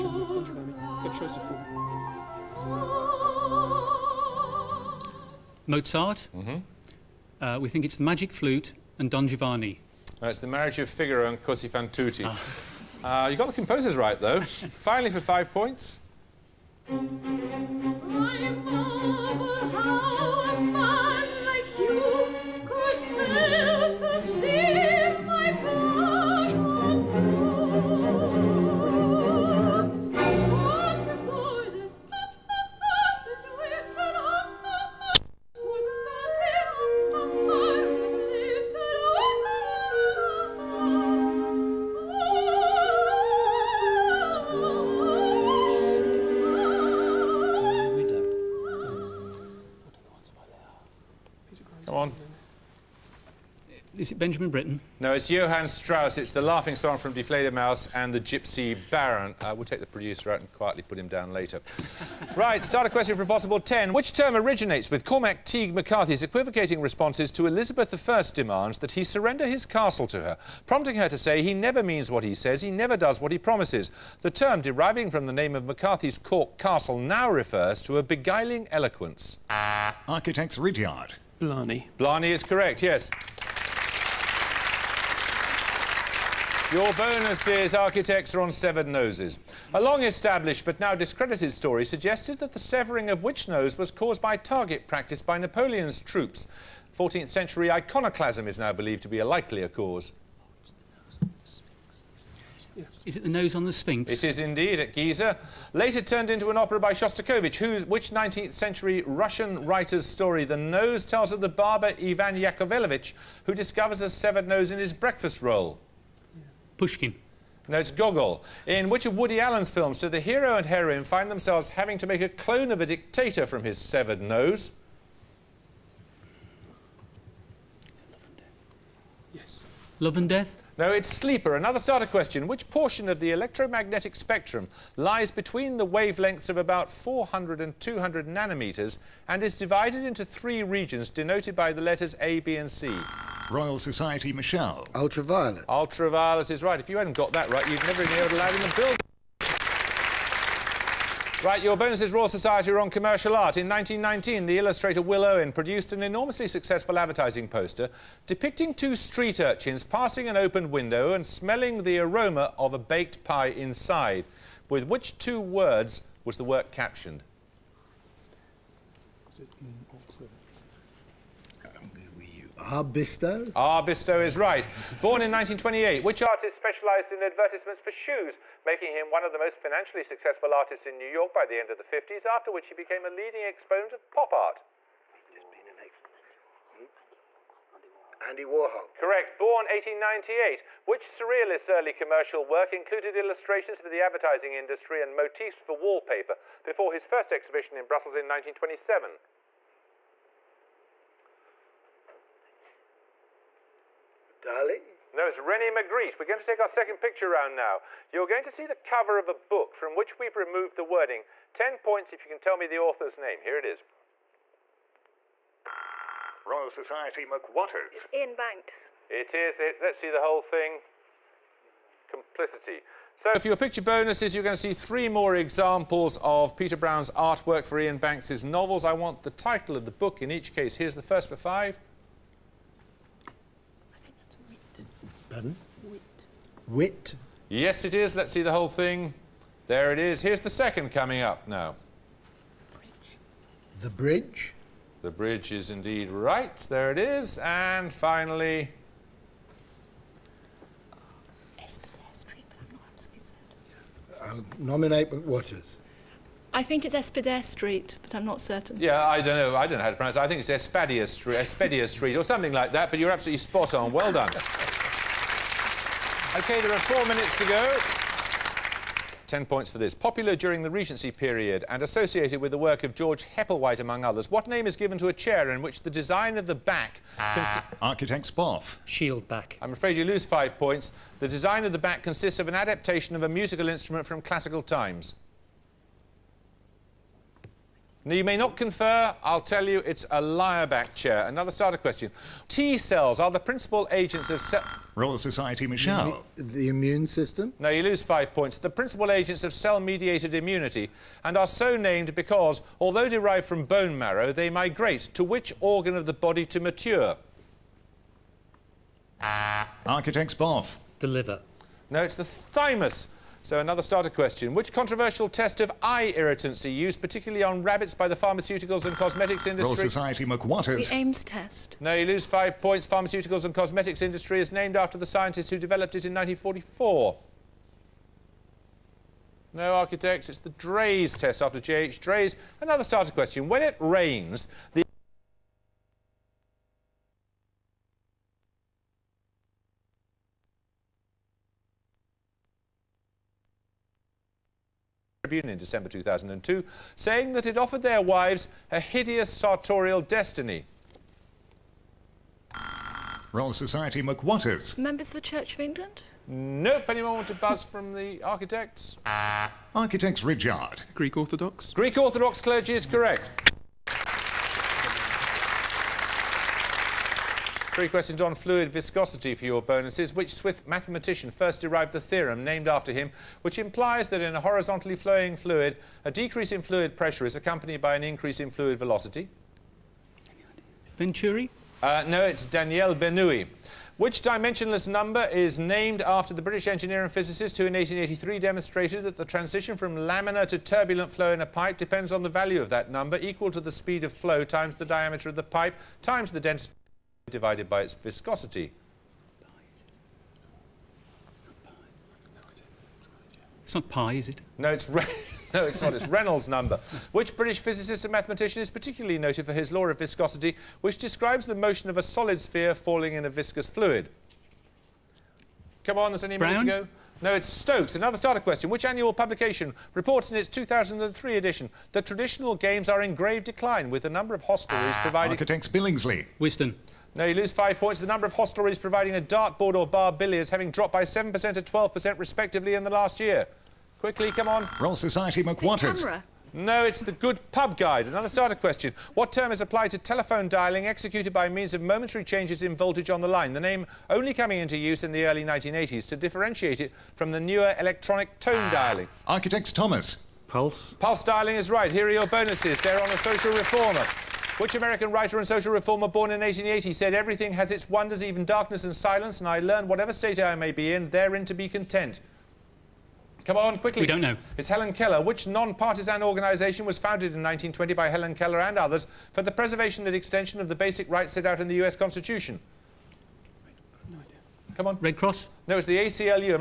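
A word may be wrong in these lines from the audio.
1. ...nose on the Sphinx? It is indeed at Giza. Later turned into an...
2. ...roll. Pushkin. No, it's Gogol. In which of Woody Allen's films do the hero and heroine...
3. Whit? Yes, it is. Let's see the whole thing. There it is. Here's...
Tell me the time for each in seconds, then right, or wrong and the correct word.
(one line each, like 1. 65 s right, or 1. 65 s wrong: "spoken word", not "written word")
1. 103 s right
2. 115 s right
3. 236 s right.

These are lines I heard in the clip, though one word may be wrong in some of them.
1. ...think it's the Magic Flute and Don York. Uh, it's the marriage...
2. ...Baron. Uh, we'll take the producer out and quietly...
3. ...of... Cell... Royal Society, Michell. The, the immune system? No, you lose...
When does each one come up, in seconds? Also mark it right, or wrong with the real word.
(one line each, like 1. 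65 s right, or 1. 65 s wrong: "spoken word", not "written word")
1. 7 s wrong: "Giovanni", not "York"
2. 58 s right
3. 294 s right.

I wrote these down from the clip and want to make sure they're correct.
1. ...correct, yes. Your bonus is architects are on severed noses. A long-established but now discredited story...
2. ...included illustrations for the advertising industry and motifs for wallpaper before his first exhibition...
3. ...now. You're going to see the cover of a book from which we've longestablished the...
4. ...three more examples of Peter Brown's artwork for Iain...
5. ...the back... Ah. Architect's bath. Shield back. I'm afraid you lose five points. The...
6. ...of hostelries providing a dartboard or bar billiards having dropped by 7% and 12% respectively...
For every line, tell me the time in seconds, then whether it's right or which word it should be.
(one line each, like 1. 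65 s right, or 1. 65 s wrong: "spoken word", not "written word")
1. 82 s right
2. 192 s right
3. 207 s wrong: "removed", not "longestablished"
4. 224 s right
5. 276 s right
6. 428 s right.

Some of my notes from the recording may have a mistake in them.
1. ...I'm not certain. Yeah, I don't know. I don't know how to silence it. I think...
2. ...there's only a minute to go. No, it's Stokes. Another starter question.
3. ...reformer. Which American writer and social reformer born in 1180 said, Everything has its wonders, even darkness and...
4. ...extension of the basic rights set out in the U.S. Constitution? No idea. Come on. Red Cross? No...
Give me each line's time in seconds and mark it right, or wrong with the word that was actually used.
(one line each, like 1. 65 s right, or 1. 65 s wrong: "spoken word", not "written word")
1. 258 s wrong: "pronounce", not "silence"
2. 416 s right
3. 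453 s wrong: "1880", not "1180"
4. 470 s right.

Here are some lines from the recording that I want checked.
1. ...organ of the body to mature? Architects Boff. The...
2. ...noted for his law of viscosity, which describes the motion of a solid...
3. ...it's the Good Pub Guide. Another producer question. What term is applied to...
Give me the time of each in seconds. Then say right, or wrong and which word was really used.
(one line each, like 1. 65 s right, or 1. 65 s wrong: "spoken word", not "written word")
1. 305 s right
2. 409 s right
3. 436 s wrong: "starter", not "producer".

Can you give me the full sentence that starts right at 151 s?
Right, your bonus is Royal Society are on commercial art.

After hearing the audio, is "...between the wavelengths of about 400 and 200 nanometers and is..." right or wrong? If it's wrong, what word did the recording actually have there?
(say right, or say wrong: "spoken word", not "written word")
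right.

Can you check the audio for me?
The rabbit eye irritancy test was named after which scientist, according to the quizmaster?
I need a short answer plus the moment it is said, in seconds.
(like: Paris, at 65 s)
J.H. Draize, at 331 s.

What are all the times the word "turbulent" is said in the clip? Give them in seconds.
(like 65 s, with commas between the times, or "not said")
390 s.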